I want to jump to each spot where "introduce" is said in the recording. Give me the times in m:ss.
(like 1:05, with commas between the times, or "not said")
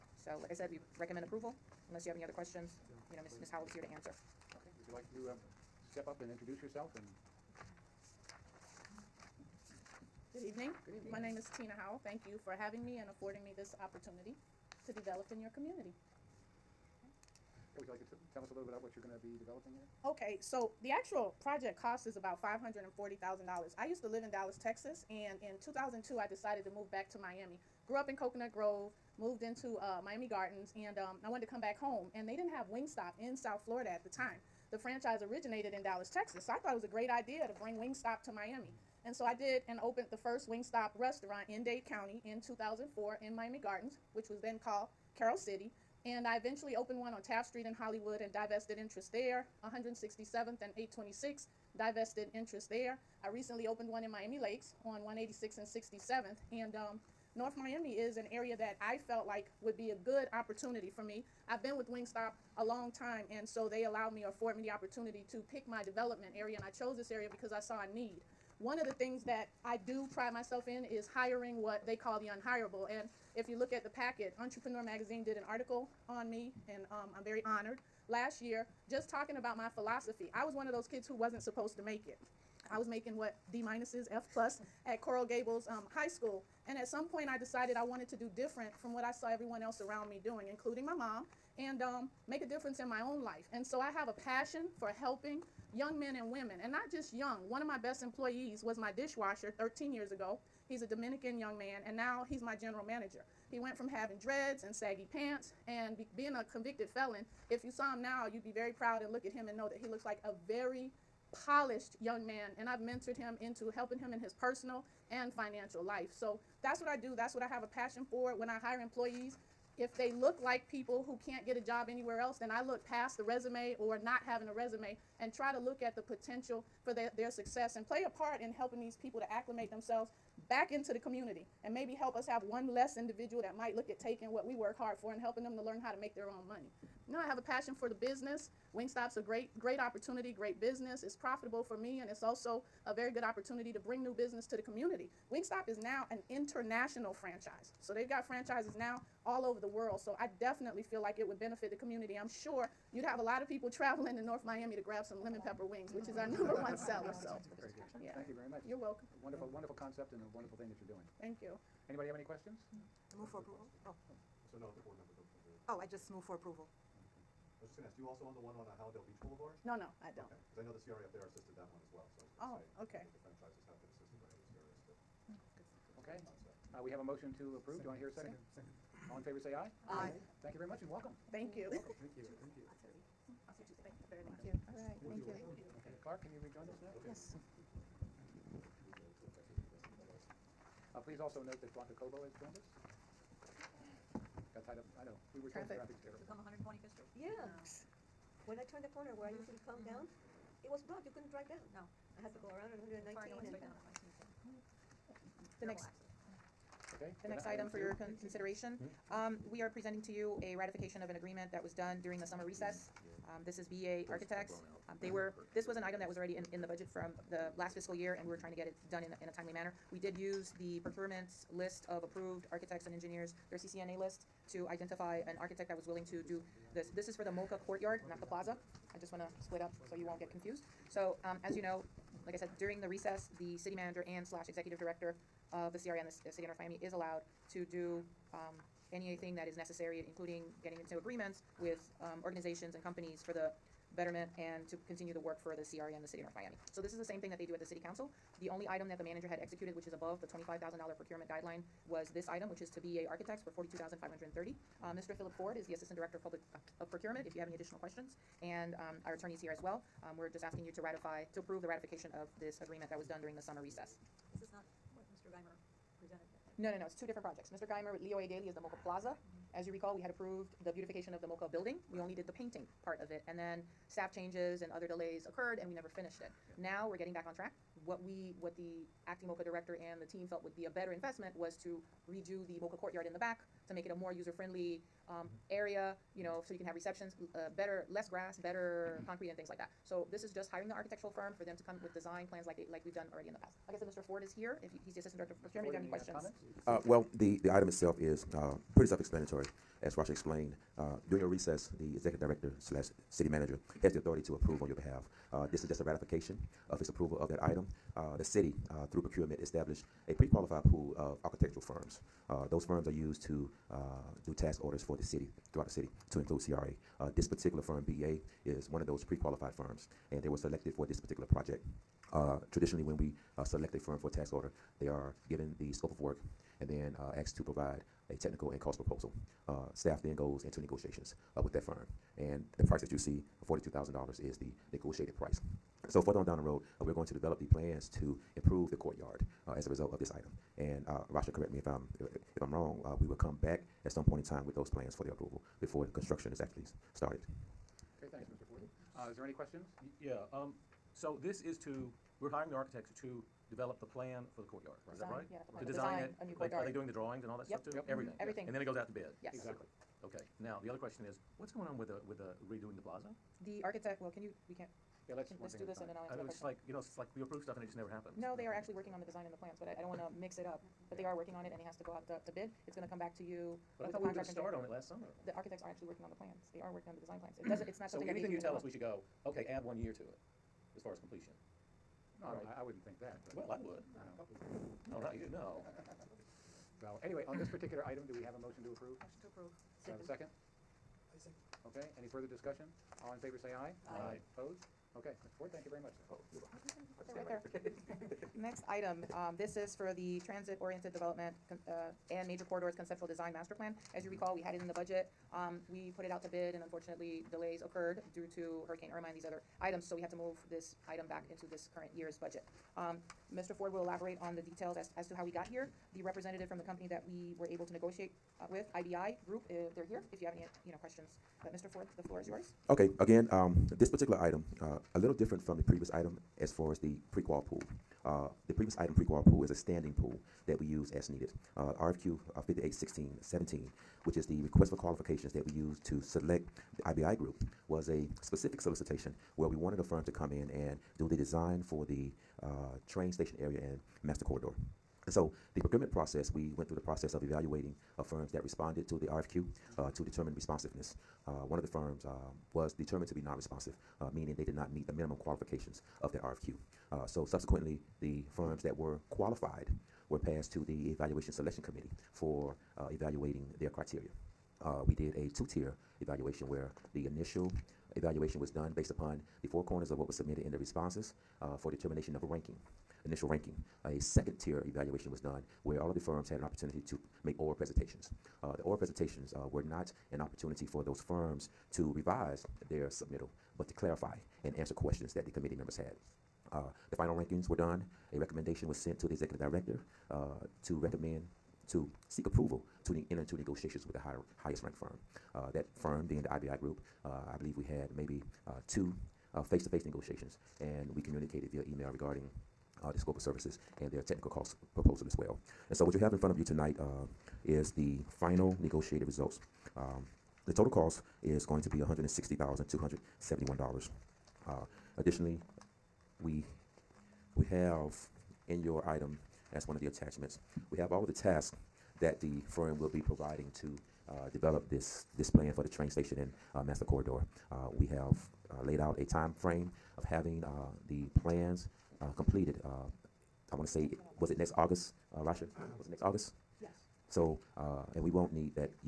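0:06.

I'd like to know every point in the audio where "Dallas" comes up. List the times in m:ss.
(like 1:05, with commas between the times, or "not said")
0:24, 0:35.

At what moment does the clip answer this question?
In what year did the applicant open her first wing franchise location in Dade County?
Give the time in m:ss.
0:42.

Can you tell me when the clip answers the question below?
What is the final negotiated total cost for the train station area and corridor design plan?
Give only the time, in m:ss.
8:31.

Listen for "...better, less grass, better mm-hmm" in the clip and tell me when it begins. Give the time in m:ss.
4:47.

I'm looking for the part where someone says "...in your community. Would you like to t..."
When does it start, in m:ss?
0:15.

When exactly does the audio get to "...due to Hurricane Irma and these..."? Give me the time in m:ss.
6:48.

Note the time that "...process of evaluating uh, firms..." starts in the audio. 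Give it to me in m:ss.
7:26.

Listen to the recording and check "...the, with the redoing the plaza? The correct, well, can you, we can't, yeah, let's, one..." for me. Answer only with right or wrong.
wrong.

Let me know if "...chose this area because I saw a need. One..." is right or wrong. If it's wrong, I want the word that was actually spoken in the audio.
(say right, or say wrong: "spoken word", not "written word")
right.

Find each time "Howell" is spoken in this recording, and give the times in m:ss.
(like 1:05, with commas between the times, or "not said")
0:03, 0:11.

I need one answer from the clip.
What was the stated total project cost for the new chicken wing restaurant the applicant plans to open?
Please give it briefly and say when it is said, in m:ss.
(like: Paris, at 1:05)
$540,000, at 0:22.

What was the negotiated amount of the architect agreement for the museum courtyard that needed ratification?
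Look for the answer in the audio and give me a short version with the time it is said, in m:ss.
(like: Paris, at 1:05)
$42,530, at 4:13.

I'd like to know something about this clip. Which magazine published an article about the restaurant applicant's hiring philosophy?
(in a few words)
Entrepreneur Magazine.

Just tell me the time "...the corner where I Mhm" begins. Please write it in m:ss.
3:18.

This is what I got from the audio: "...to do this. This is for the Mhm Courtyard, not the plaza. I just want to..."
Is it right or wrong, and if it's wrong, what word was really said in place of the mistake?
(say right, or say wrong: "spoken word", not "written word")
wrong: "MOCA", not "Mhm".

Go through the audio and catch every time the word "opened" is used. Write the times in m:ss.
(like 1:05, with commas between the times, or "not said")
0:39, 0:46, 0:53.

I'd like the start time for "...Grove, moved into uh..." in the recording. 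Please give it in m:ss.
0:28.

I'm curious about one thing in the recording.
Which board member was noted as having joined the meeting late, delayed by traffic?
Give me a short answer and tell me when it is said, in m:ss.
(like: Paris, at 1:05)
Blanca Cobo, at 3:11.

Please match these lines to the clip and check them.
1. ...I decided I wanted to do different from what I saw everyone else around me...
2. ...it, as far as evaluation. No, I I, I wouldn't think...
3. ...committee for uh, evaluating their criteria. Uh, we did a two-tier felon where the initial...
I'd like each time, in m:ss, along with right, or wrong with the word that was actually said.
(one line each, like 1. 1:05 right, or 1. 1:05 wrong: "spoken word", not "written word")
1. 1:27 right
2. 6:20 wrong: "completion", not "evaluation"
3. 7:41 wrong: "evaluation", not "felon".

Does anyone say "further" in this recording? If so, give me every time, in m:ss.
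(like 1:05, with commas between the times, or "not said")
5:36, 6:32.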